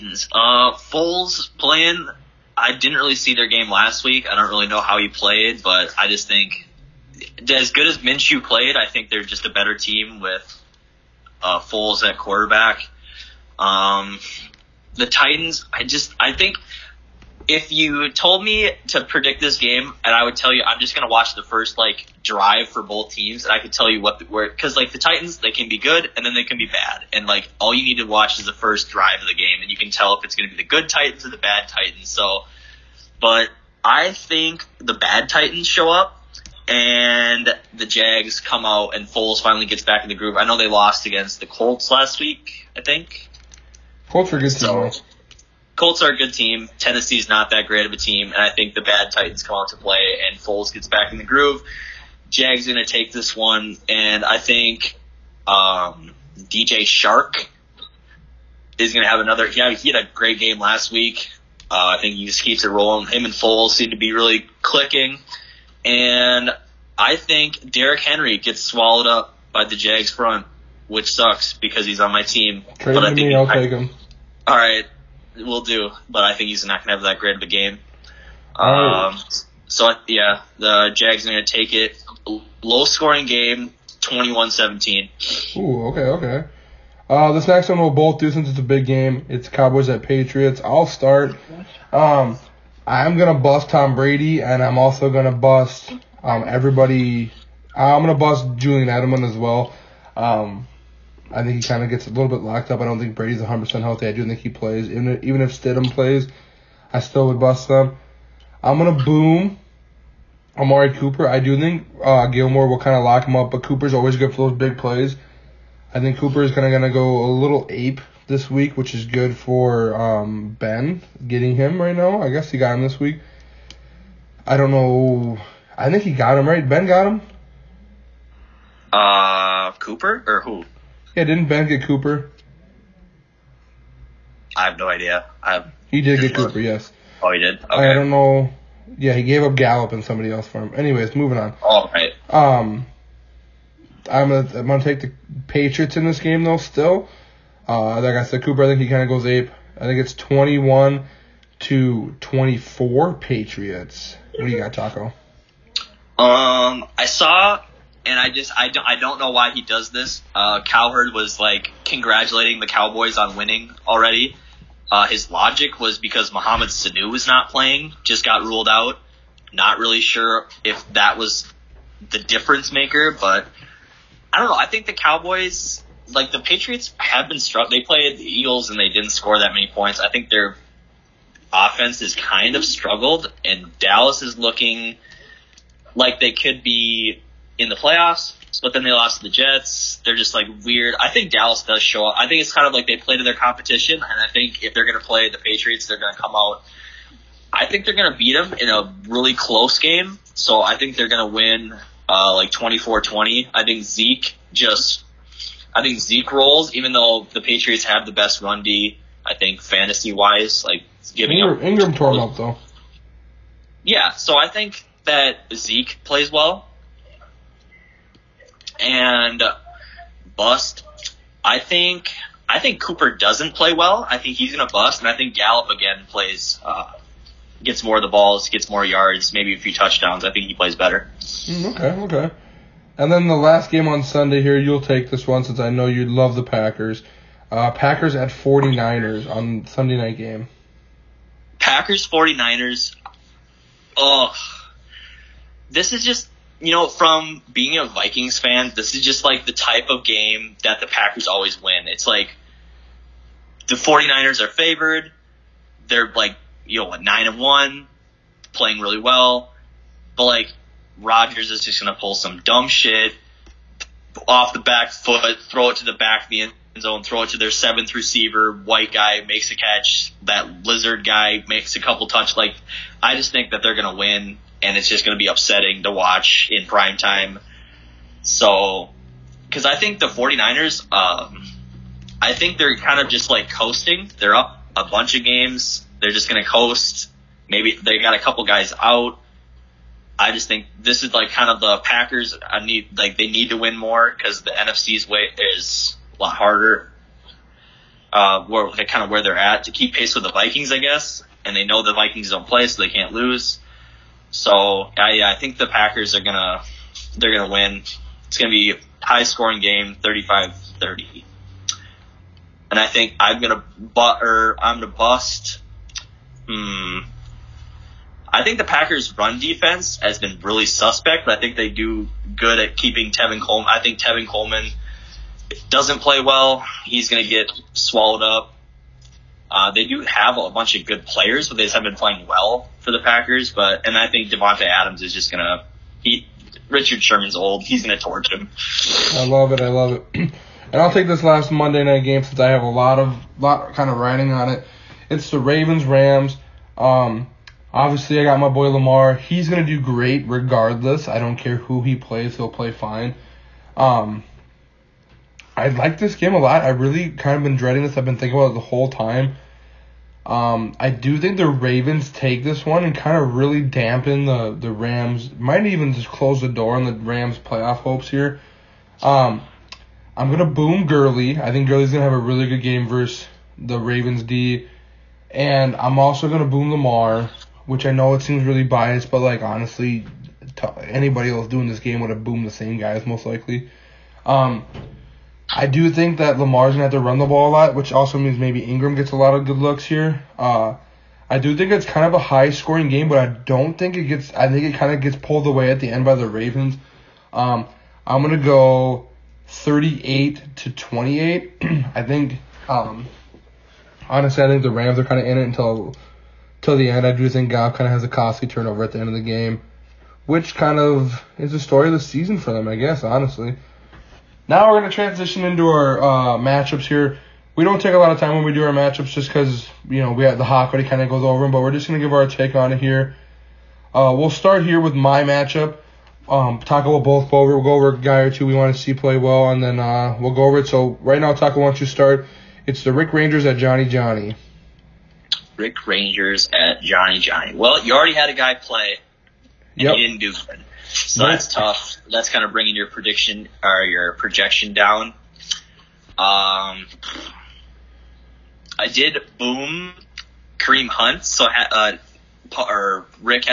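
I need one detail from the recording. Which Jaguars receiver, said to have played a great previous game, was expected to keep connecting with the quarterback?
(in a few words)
DJ Chark.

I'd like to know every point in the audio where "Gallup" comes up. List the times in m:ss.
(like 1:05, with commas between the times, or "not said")
2:19, 3:45.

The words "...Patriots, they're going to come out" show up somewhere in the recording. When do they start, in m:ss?
3:15.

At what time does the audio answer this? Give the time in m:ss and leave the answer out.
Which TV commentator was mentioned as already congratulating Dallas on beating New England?
2:40.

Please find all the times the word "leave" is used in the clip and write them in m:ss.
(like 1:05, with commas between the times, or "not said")
not said.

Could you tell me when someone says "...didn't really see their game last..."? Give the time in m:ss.
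0:02.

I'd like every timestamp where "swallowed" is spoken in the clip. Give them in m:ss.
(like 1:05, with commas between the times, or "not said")
1:08, 5:27.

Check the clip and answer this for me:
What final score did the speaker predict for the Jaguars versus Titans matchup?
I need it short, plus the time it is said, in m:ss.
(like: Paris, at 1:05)
21-17, at 1:24.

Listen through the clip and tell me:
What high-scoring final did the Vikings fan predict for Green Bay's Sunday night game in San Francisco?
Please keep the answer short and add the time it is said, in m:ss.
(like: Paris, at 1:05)
35-30, at 5:10.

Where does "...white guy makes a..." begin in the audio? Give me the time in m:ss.
4:28.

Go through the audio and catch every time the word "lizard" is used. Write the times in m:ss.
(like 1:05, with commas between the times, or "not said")
4:30.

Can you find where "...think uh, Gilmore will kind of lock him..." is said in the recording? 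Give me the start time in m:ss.
1:51.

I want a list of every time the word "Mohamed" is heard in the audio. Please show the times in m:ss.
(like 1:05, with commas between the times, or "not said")
2:46.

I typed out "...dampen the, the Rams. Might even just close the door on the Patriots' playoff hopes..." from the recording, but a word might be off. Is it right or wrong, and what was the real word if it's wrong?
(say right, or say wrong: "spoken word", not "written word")
wrong: "Rams", not "Patriots".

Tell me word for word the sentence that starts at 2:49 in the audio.
Not really sure if that was the difference maker, but I don't know.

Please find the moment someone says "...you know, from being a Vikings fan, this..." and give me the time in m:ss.
4:06.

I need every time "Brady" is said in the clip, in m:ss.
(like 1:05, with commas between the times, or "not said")
1:33, 1:43.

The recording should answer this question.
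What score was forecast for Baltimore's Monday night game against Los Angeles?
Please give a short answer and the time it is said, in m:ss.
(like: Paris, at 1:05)
38 to 28, at 6:39.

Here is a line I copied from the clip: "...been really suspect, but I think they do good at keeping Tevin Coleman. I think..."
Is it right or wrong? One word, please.
right.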